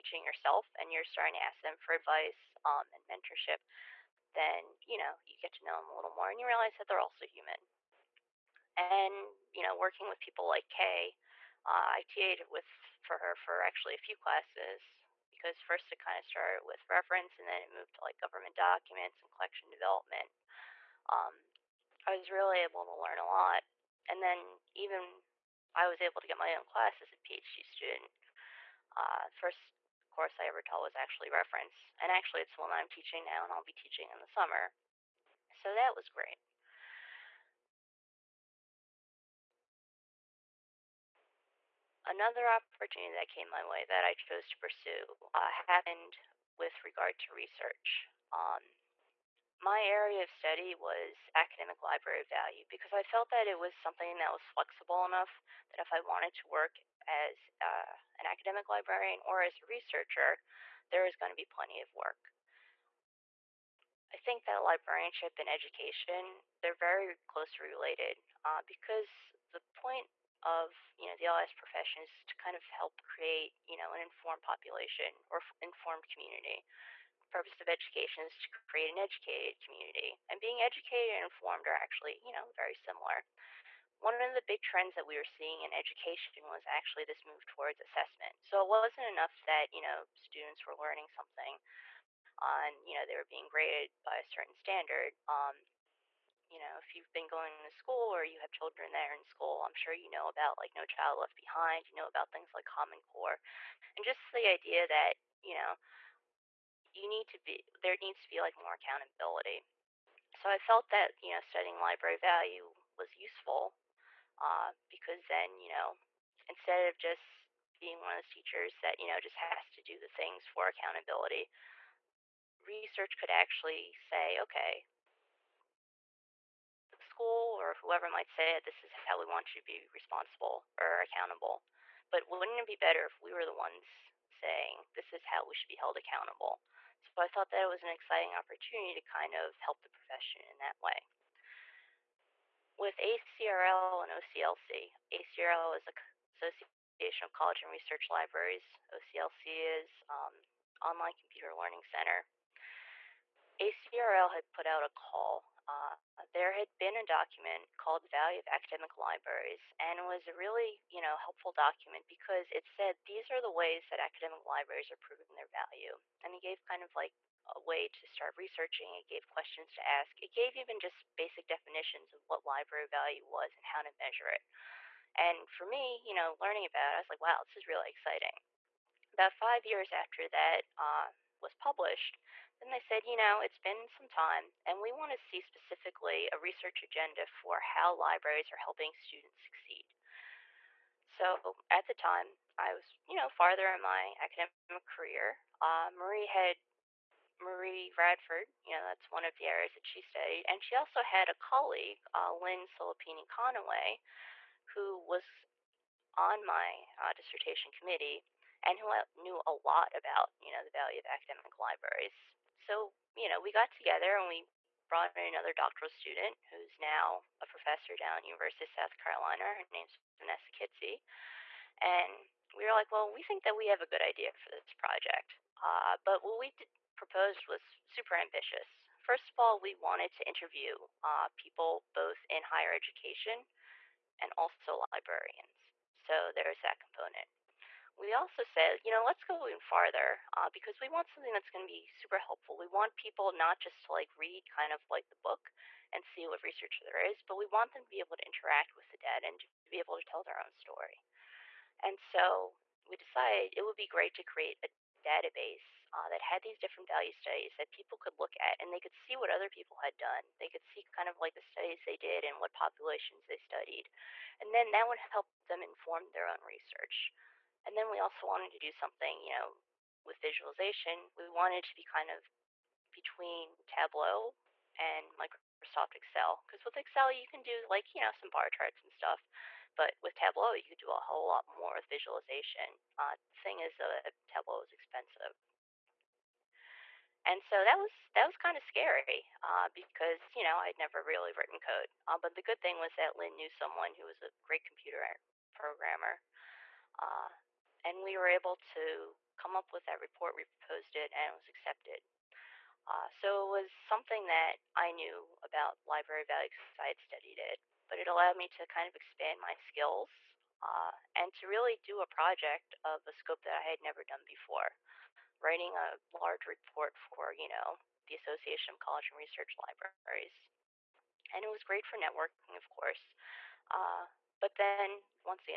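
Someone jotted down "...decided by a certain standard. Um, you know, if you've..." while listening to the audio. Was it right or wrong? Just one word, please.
wrong.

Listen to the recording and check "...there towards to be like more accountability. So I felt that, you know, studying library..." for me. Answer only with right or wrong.
wrong.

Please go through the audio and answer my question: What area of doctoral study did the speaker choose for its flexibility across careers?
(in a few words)
Academic library value.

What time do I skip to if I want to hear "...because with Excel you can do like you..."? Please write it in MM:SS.
04:36.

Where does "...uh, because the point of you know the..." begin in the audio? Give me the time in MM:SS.
01:08.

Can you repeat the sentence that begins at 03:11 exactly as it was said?
So at the time, I was, you know, farther in my academic career.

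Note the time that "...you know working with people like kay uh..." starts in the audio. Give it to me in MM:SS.
00:09.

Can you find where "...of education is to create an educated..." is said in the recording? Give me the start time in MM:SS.
01:17.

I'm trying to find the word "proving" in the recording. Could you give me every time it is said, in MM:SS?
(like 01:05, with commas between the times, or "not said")
02:45.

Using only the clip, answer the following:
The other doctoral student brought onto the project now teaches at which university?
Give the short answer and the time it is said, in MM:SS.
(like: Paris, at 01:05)
University of South Carolina, at 03:38.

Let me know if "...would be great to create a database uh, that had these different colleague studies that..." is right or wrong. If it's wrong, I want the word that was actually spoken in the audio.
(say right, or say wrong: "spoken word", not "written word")
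wrong: "value", not "colleague".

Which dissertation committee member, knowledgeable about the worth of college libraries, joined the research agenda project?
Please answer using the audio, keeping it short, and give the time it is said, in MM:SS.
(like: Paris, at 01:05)
Lynn Silipigni Connaway, at 03:22.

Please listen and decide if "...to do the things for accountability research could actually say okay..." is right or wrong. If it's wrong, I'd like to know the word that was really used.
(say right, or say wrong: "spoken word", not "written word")
right.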